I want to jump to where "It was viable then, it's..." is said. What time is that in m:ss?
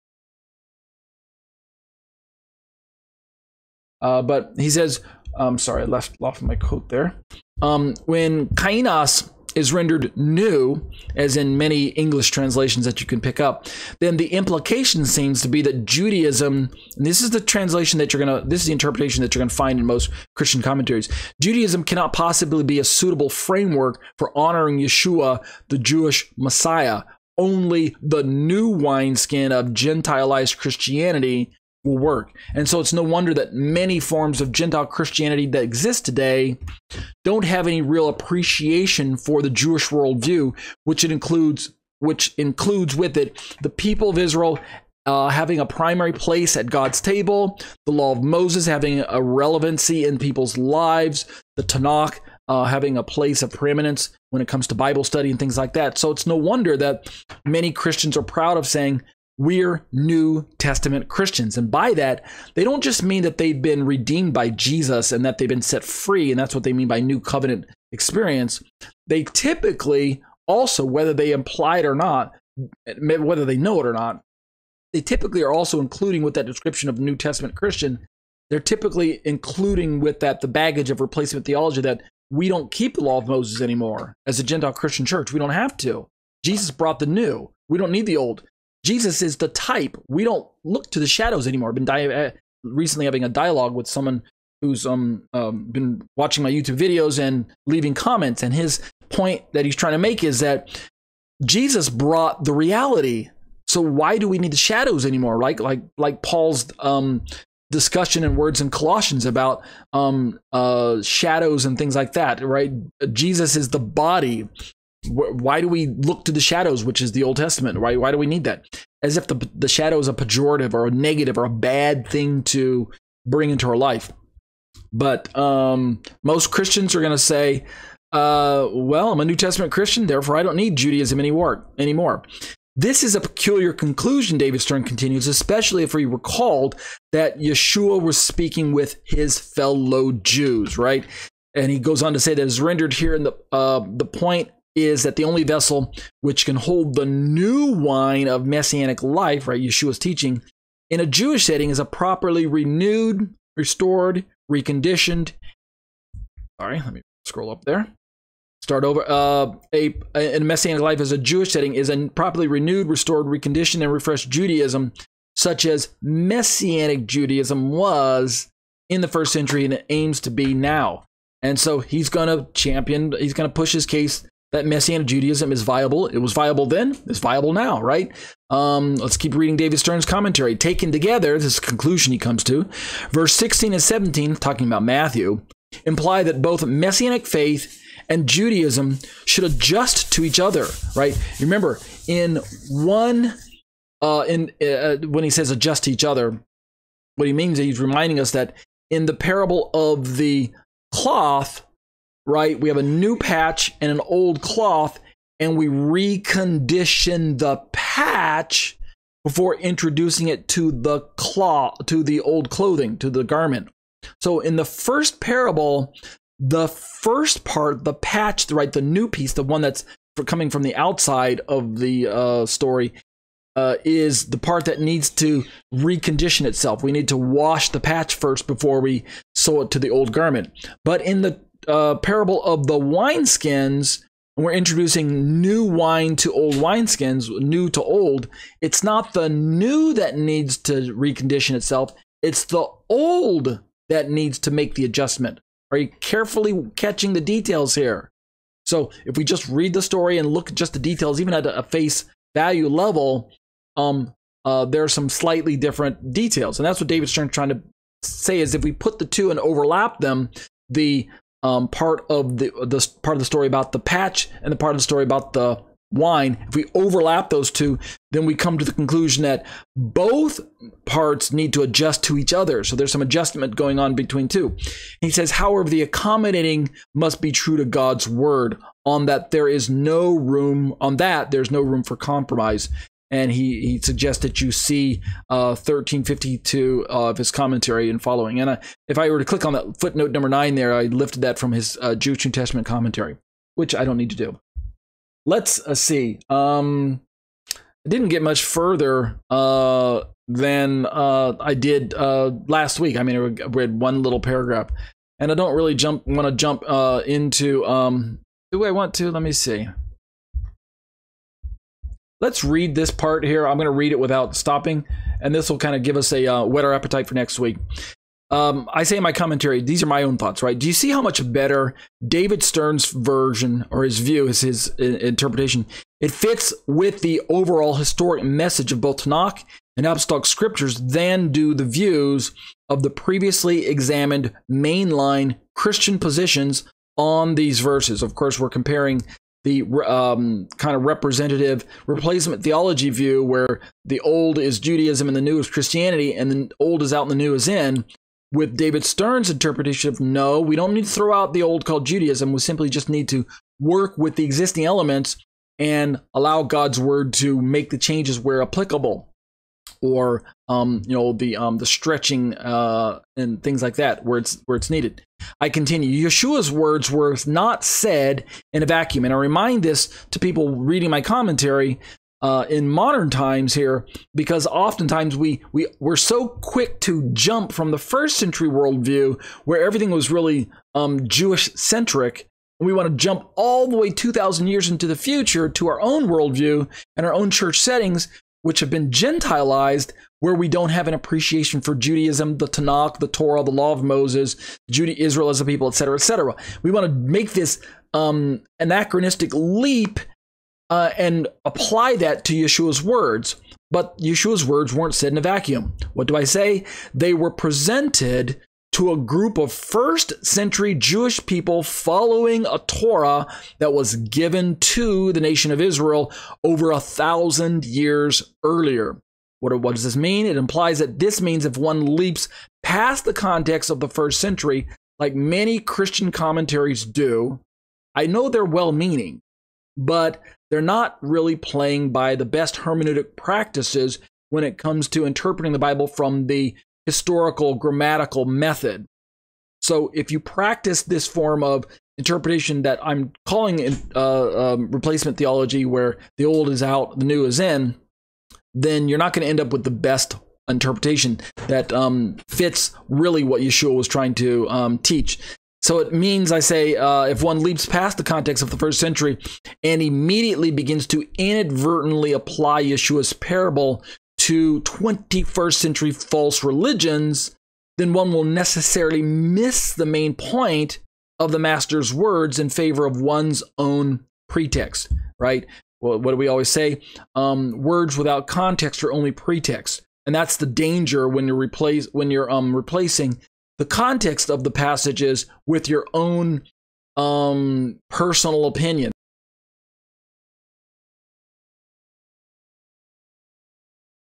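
2:56.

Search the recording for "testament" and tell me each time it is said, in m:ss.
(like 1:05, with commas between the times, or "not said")
1:00, 1:17, 1:57, 2:09, 4:52.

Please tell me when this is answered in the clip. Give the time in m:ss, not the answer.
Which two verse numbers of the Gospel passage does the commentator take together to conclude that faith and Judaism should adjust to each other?
3:03.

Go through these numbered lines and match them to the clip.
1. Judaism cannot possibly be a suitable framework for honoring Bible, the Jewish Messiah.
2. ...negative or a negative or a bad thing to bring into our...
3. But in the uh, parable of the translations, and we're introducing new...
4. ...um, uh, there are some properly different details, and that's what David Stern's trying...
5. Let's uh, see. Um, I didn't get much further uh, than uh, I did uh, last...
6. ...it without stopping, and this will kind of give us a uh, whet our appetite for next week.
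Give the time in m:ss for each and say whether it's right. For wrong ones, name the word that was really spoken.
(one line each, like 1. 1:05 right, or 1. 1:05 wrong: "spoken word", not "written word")
1. 0:21 wrong: "Yeshua", not "Bible"
2. 2:00 wrong: "pejorative", not "negative"
3. 3:50 wrong: "wineskins", not "translations"
4. 4:13 wrong: "slightly", not "properly"
5. 4:55 right
6. 5:13 right.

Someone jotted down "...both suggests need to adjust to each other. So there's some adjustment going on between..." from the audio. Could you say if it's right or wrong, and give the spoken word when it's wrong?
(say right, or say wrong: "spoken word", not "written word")
wrong: "parts", not "suggests".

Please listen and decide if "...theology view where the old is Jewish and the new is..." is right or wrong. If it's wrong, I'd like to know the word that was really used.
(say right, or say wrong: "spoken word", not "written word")
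wrong: "Judaism", not "Jewish".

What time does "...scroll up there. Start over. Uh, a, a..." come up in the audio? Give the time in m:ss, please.
2:37.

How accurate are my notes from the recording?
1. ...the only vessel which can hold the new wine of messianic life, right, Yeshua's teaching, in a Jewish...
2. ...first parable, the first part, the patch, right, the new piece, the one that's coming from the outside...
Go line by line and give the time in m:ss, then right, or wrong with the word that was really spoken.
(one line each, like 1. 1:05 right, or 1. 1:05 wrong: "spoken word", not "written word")
1. 2:25 right
2. 3:34 right.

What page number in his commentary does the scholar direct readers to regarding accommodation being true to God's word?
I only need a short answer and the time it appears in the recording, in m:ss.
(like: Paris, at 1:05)
1352, at 4:45.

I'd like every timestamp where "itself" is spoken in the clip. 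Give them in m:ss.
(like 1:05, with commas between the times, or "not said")
3:46, 4:01.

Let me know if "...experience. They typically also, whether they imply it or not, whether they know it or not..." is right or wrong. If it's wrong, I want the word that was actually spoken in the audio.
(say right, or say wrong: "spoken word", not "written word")
right.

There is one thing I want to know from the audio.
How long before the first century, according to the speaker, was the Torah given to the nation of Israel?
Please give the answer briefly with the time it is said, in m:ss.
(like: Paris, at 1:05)
over a thousand years, at 6:56.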